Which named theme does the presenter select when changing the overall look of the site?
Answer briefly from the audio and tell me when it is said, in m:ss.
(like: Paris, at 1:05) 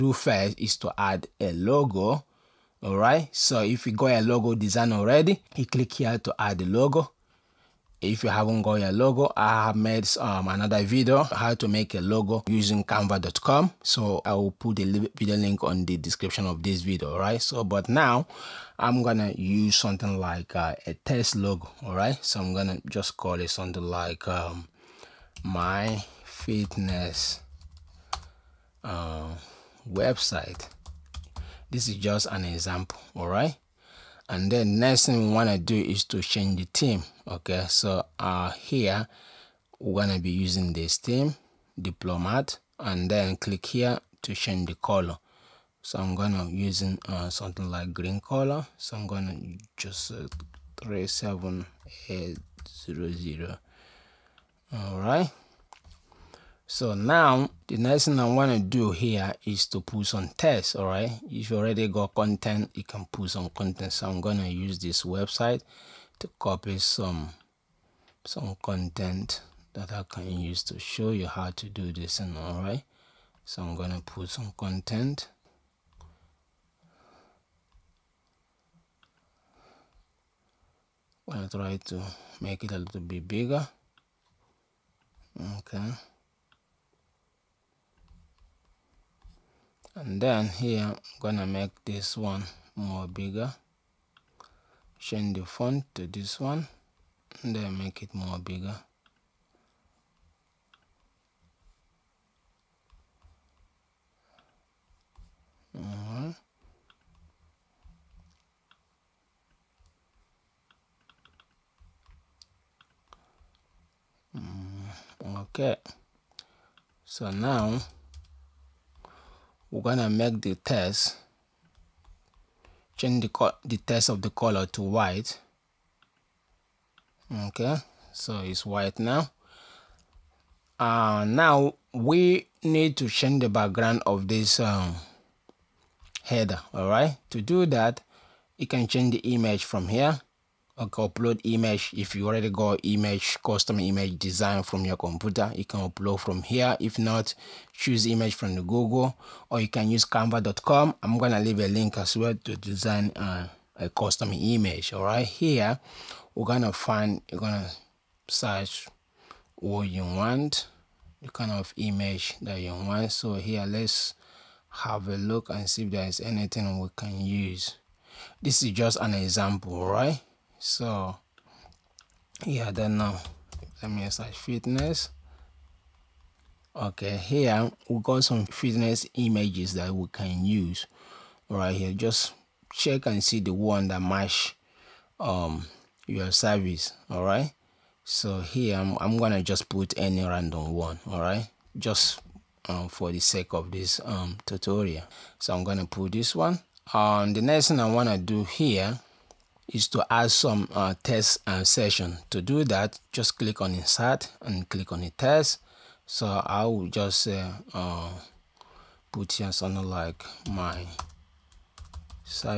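Diplomat, at 0:41.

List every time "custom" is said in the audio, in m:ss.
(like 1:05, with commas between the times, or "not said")
2:23, 2:33.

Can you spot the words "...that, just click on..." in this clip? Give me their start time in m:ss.
3:22.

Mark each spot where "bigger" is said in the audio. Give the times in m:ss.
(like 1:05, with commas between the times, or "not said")
1:23, 1:33, 1:38.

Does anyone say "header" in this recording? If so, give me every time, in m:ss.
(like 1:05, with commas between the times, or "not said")
2:16.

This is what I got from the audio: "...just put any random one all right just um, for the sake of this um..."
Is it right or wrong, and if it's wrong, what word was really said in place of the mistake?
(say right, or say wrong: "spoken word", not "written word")
right.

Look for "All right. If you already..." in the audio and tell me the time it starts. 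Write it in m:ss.
1:00.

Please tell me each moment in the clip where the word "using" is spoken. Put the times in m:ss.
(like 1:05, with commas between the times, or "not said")
0:12, 0:40, 0:46.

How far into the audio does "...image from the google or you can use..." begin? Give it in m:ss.
2:28.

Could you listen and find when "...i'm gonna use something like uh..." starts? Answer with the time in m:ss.
0:18.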